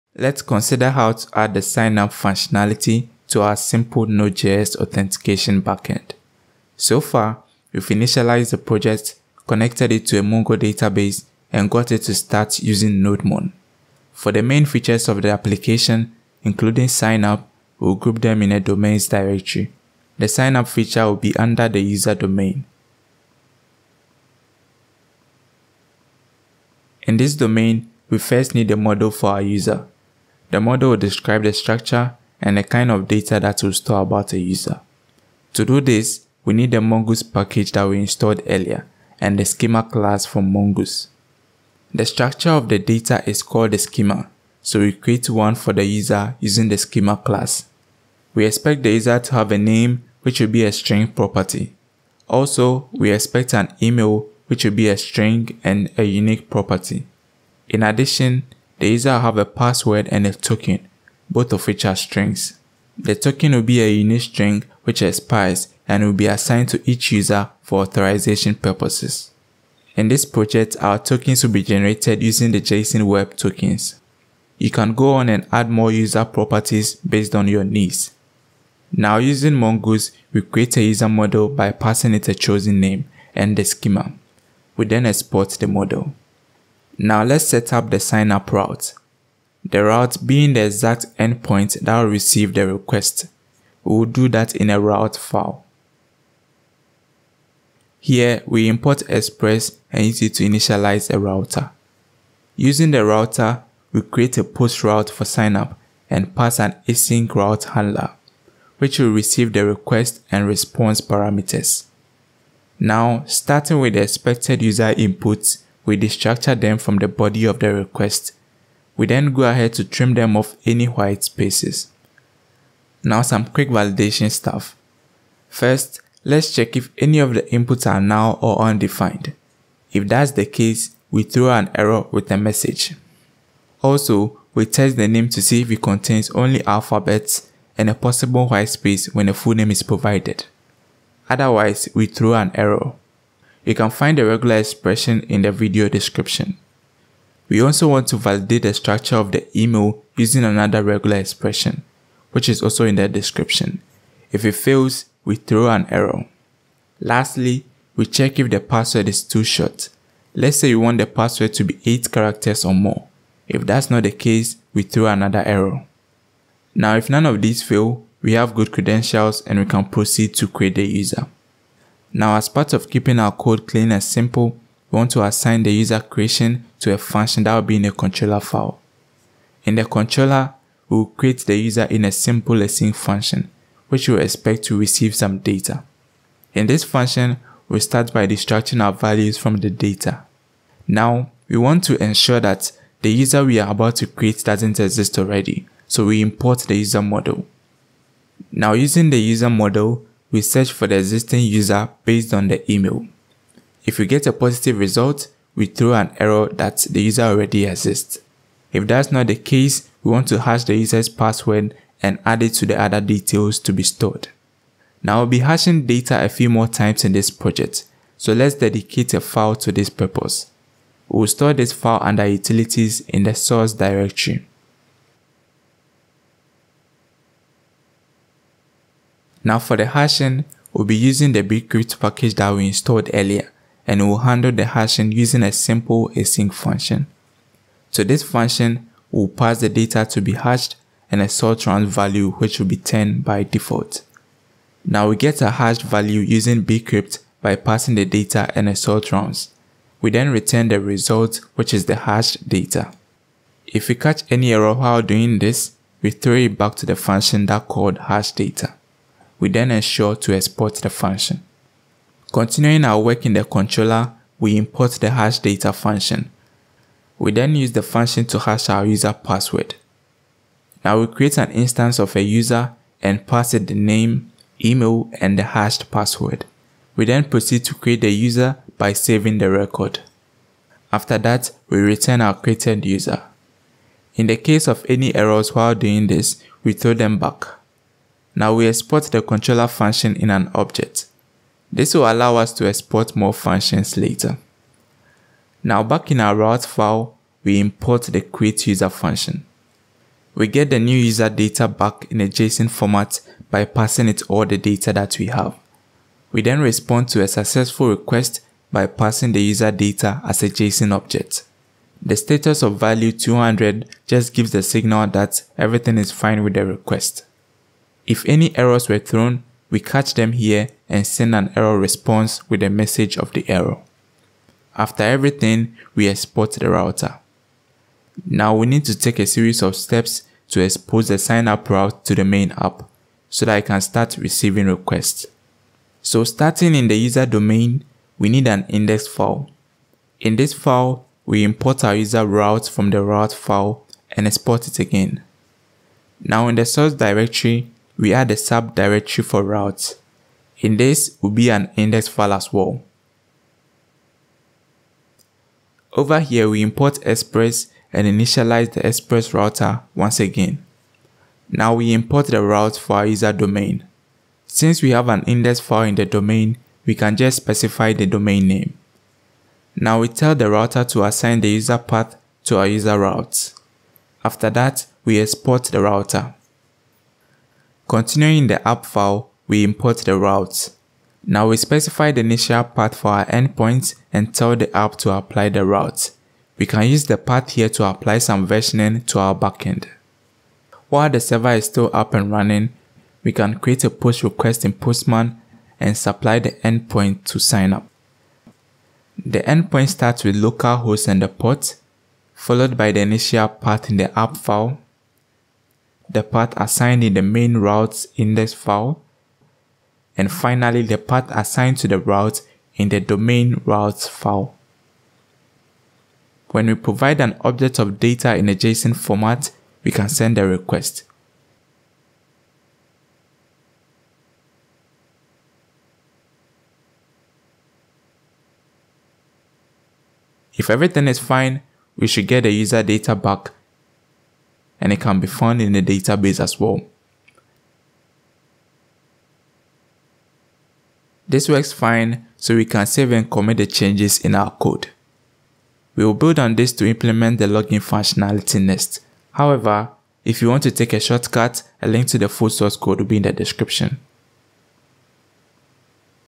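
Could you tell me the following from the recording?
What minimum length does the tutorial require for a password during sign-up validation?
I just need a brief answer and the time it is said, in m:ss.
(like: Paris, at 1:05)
8 characters, at 2:41.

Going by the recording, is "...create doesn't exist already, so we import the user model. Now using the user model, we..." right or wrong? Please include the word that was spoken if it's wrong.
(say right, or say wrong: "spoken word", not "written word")
right.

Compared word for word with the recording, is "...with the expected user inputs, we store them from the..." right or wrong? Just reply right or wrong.
wrong.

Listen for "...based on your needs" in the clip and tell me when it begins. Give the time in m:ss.
1:16.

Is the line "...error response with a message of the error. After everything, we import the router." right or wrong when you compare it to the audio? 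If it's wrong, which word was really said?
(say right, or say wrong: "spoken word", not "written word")
wrong: "export", not "import".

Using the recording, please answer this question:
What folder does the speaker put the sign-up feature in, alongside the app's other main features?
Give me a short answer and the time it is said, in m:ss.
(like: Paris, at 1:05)
domains directory, at 0:18.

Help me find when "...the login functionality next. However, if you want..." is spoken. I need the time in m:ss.
7:27.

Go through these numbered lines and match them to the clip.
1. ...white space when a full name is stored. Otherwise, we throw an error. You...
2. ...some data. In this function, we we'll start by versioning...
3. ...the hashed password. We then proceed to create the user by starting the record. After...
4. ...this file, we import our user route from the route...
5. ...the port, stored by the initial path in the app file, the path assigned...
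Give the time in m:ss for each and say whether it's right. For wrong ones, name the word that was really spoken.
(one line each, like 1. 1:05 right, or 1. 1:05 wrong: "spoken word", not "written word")
1. 2:18 wrong: "provided", not "stored"
2. 3:05 wrong: "extracting", not "versioning"
3. 4:35 wrong: "saving", not "starting"
4. 5:40 right
5. 6:41 wrong: "followed", not "stored".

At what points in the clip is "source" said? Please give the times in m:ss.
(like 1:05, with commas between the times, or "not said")
3:43, 5:46, 7:32.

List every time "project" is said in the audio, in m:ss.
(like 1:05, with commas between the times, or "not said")
0:08, 1:10, 3:37.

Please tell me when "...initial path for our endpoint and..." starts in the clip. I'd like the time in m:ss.
6:22.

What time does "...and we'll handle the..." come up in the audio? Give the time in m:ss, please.
3:53.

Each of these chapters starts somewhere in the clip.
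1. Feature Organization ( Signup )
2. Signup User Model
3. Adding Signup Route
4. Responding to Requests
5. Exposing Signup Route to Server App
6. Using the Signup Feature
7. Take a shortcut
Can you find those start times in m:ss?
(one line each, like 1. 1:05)
1. 0:13
2. 0:26
3. 1:27
4. 5:06
5. 5:27
6. 6:30
7. 7:26.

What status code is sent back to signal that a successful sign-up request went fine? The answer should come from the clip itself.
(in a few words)
200.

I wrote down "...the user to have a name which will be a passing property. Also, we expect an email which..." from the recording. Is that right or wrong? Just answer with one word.
wrong.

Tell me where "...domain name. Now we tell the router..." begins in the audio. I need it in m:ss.
6:08.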